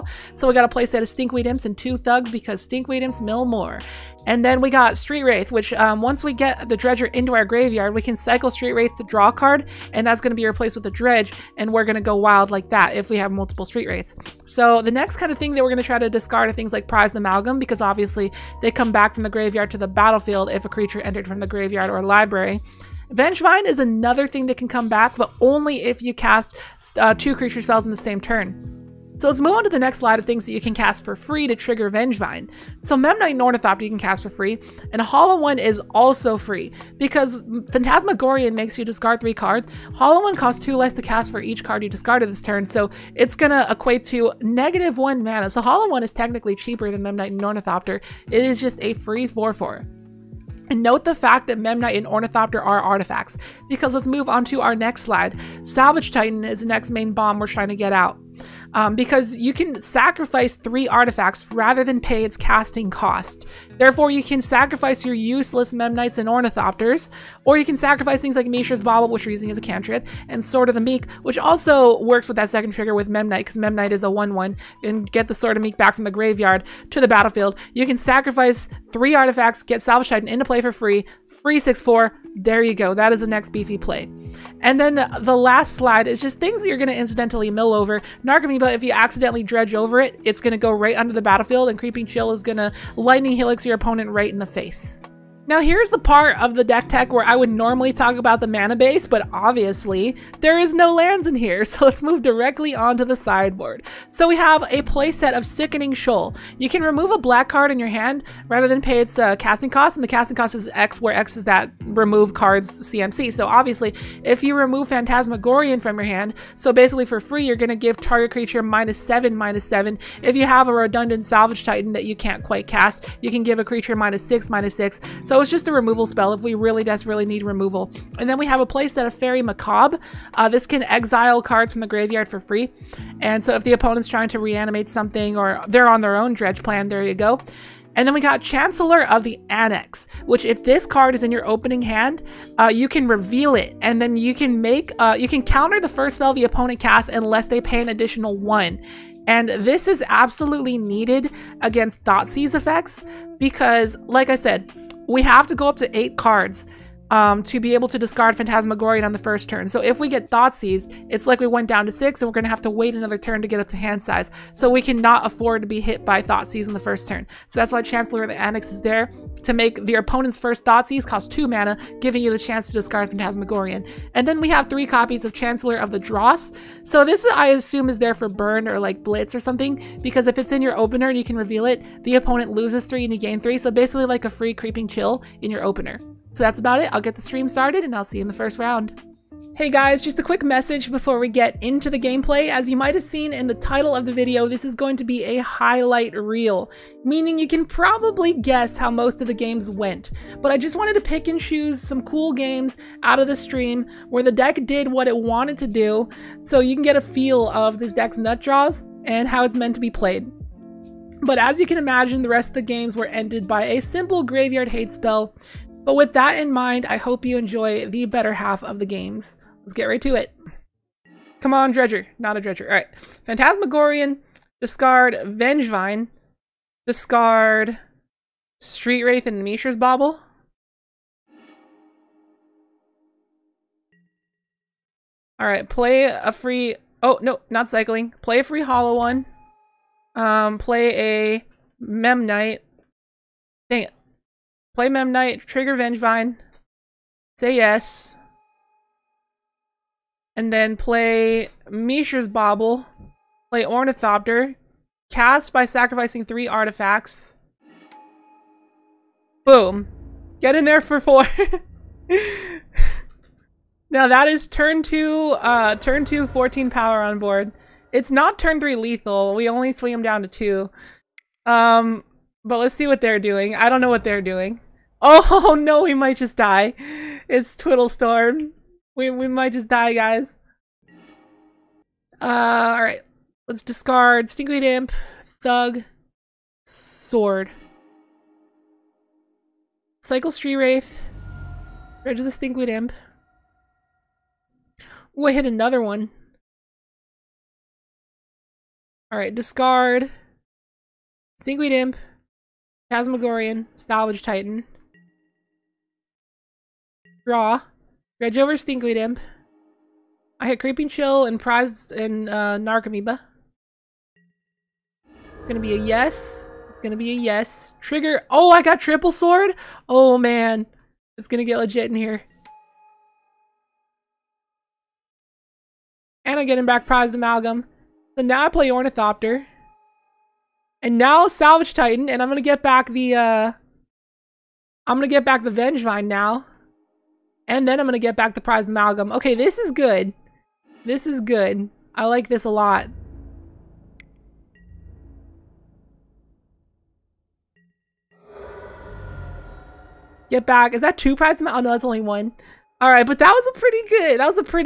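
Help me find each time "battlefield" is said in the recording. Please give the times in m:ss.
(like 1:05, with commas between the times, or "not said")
0:19, 1:17, 1:31.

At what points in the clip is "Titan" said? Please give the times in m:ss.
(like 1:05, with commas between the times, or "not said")
0:56, 1:20, 2:01, 5:04, 5:31.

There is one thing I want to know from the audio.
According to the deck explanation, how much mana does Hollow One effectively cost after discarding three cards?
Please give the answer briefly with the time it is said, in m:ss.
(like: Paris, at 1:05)
-1, at 0:44.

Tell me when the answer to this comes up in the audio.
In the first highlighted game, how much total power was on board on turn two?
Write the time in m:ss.
4:26.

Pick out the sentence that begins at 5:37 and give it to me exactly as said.
And then I'm gonna get back the Prize Amalgam.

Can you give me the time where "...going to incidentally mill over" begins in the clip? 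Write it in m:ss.
1:26.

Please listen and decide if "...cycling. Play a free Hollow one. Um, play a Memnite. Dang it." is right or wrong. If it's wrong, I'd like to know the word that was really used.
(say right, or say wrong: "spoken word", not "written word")
right.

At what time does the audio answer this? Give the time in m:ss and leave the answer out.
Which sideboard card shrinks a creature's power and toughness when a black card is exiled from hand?
1:45.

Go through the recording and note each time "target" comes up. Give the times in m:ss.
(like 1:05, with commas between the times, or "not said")
1:57.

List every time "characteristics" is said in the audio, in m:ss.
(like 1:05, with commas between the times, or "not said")
not said.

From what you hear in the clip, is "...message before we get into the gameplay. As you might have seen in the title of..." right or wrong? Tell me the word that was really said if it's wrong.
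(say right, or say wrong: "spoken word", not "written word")
right.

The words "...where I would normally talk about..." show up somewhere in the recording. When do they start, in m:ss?
1:37.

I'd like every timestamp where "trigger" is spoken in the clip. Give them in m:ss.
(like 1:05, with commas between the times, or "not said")
0:31, 1:12, 4:05, 5:17.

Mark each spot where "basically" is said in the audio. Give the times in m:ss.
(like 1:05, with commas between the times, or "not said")
1:56, 3:03.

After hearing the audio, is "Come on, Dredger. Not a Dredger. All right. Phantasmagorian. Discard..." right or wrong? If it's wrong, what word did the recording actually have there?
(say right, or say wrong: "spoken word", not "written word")
right.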